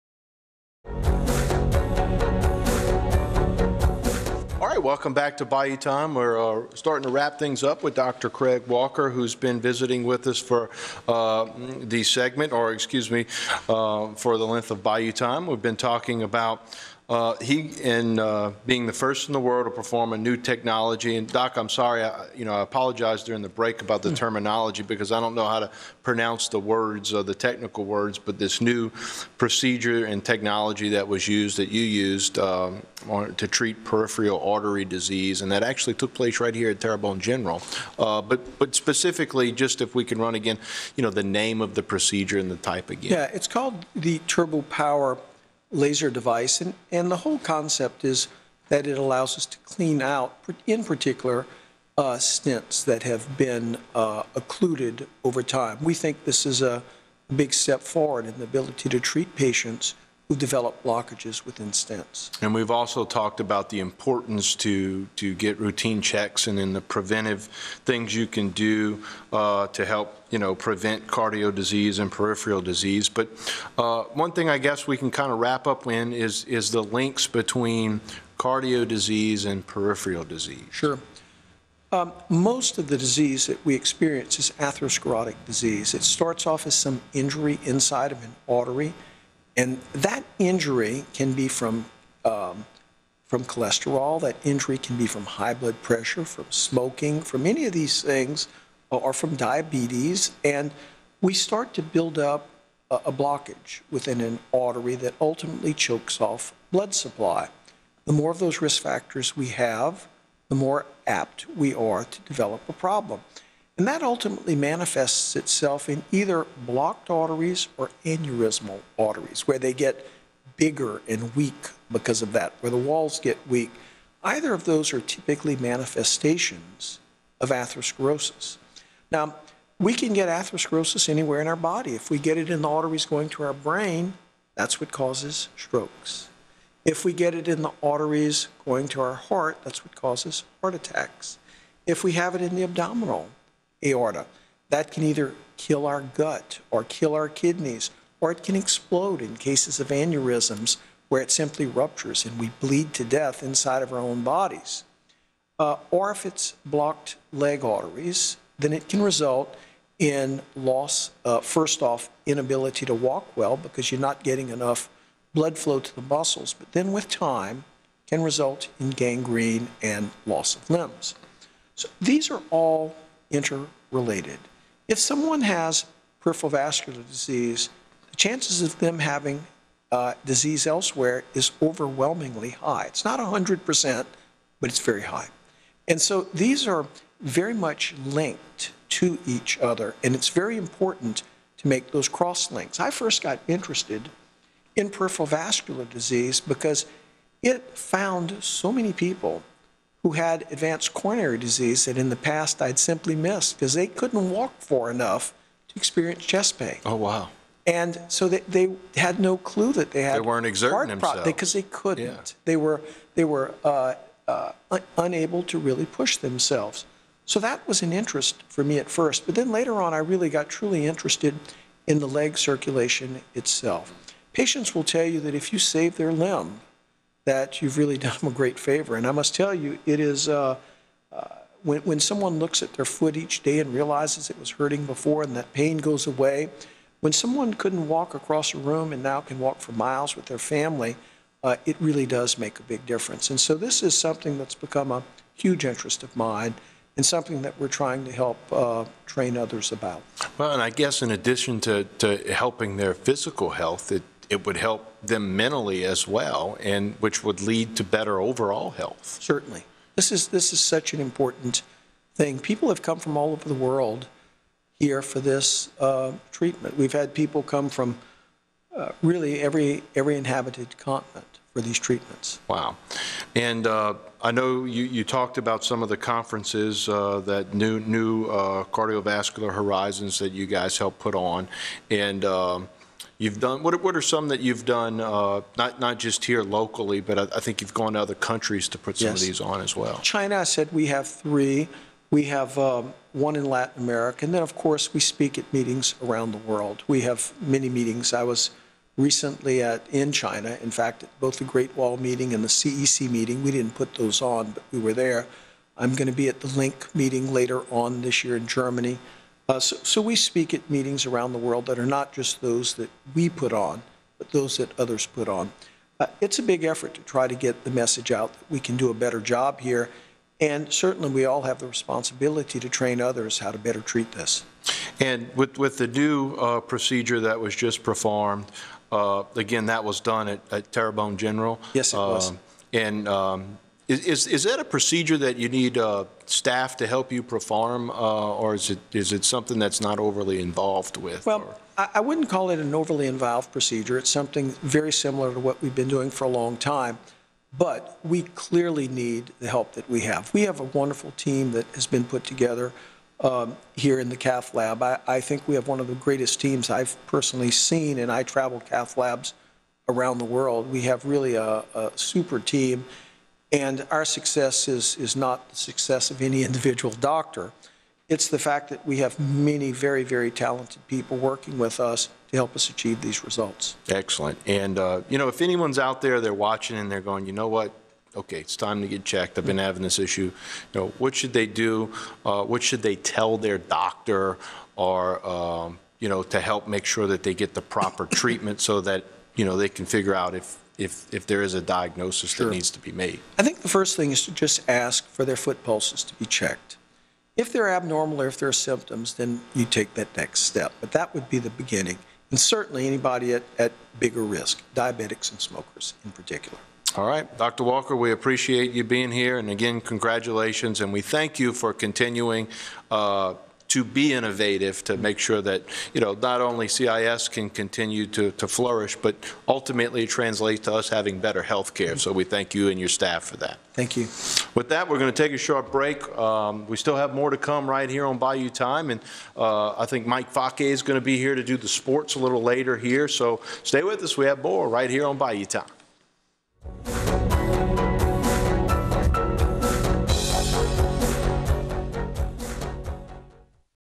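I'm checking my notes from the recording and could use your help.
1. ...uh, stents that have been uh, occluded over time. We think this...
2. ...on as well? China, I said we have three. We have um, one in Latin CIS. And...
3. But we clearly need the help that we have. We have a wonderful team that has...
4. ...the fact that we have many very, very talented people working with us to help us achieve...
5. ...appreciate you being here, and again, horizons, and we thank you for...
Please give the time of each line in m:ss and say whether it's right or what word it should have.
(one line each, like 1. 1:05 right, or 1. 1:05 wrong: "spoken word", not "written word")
1. 0:51 right
2. 4:49 wrong: "America", not "CIS"
3. 5:47 right
4. 6:08 right
5. 6:48 wrong: "congratulations", not "horizons".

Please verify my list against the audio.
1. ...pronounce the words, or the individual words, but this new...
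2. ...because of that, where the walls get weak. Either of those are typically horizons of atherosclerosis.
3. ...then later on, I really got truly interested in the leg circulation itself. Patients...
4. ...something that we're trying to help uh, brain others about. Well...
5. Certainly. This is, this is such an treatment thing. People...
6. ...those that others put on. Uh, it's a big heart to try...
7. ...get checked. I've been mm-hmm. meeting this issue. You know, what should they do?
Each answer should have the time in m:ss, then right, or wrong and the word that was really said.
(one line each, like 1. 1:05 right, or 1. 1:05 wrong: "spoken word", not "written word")
1. 0:26 wrong: "technical", not "individual"
2. 2:01 wrong: "manifestations", not "horizons"
3. 3:39 right
4. 4:07 wrong: "train", not "brain"
5. 4:19 wrong: "important", not "treatment"
6. 5:14 wrong: "effort", not "heart"
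7. 6:18 wrong: "having", not "meeting".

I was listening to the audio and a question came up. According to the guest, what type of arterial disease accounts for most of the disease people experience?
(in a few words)
Atherosclerotic disease.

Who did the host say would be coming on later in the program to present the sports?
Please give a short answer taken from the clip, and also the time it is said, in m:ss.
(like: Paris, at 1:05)
Mike Fake, at 7:10.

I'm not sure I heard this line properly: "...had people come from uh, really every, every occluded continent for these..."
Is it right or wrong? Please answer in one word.
wrong.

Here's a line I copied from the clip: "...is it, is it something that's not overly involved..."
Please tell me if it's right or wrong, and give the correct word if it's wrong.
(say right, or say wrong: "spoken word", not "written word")
right.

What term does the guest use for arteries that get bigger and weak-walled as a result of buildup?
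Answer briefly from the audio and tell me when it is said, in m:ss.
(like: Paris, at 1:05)
Aneurysmal arteries, at 1:58.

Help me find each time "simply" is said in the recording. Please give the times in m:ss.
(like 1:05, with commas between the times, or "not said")
2:31, 3:22.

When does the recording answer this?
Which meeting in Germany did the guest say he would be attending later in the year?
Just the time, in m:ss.
5:06.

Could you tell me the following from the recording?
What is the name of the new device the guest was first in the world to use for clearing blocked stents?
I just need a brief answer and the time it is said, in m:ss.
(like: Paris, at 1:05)
Turbo power laser, at 0:44.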